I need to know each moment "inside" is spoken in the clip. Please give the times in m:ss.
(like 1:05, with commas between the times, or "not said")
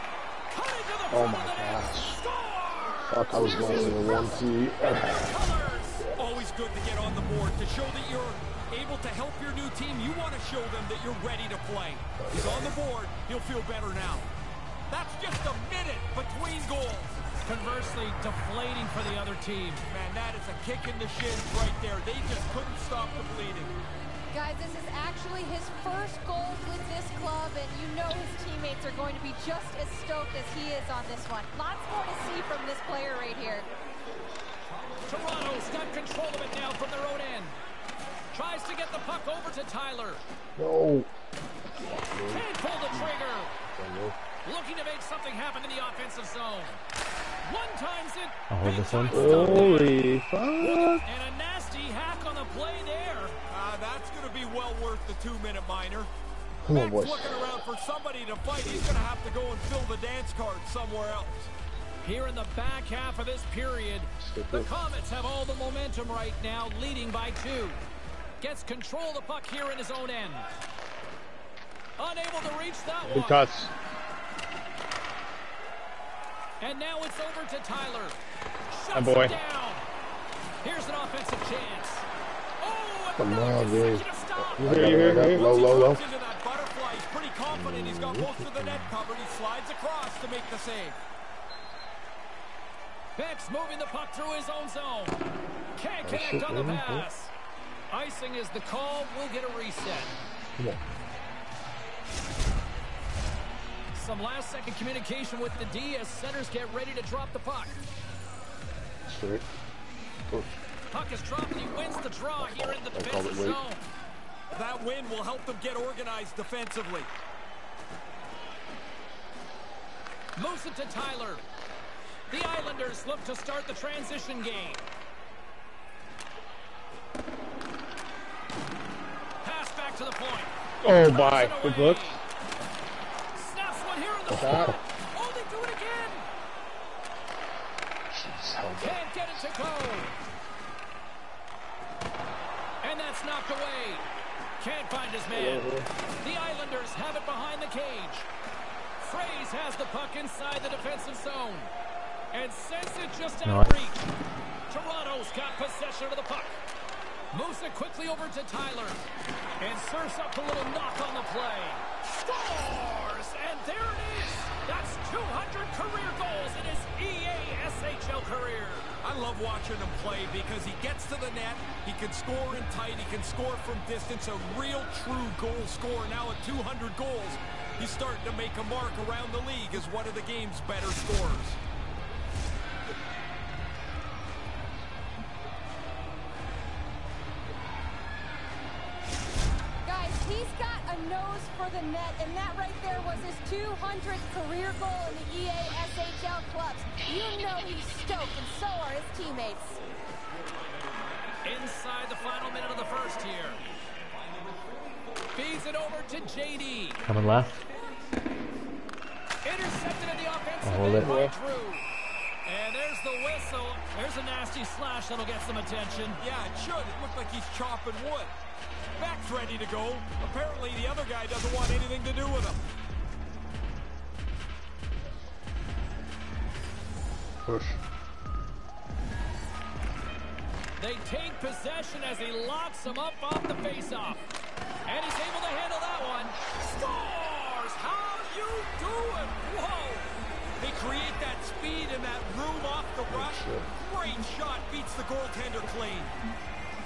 2:30, 3:21.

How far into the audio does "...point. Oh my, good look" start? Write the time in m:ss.
2:10.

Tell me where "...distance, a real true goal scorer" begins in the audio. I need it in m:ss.
2:53.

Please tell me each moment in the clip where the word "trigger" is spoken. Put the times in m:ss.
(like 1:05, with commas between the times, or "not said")
0:42.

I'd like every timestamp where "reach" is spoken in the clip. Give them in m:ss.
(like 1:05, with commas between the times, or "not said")
1:12, 2:33.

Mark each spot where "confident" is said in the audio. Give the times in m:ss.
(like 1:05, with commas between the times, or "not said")
1:27.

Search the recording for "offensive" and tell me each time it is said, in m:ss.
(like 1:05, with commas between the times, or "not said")
0:45, 1:20, 3:30.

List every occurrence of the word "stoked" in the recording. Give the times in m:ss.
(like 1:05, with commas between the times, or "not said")
0:30, 3:18.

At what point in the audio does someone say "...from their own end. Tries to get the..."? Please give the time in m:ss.
0:36.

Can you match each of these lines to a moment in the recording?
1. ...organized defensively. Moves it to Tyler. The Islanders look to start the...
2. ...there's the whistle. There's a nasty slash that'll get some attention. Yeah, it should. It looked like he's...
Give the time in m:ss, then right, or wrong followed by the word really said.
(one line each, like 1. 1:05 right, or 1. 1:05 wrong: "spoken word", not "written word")
1. 1:55 right
2. 3:32 right.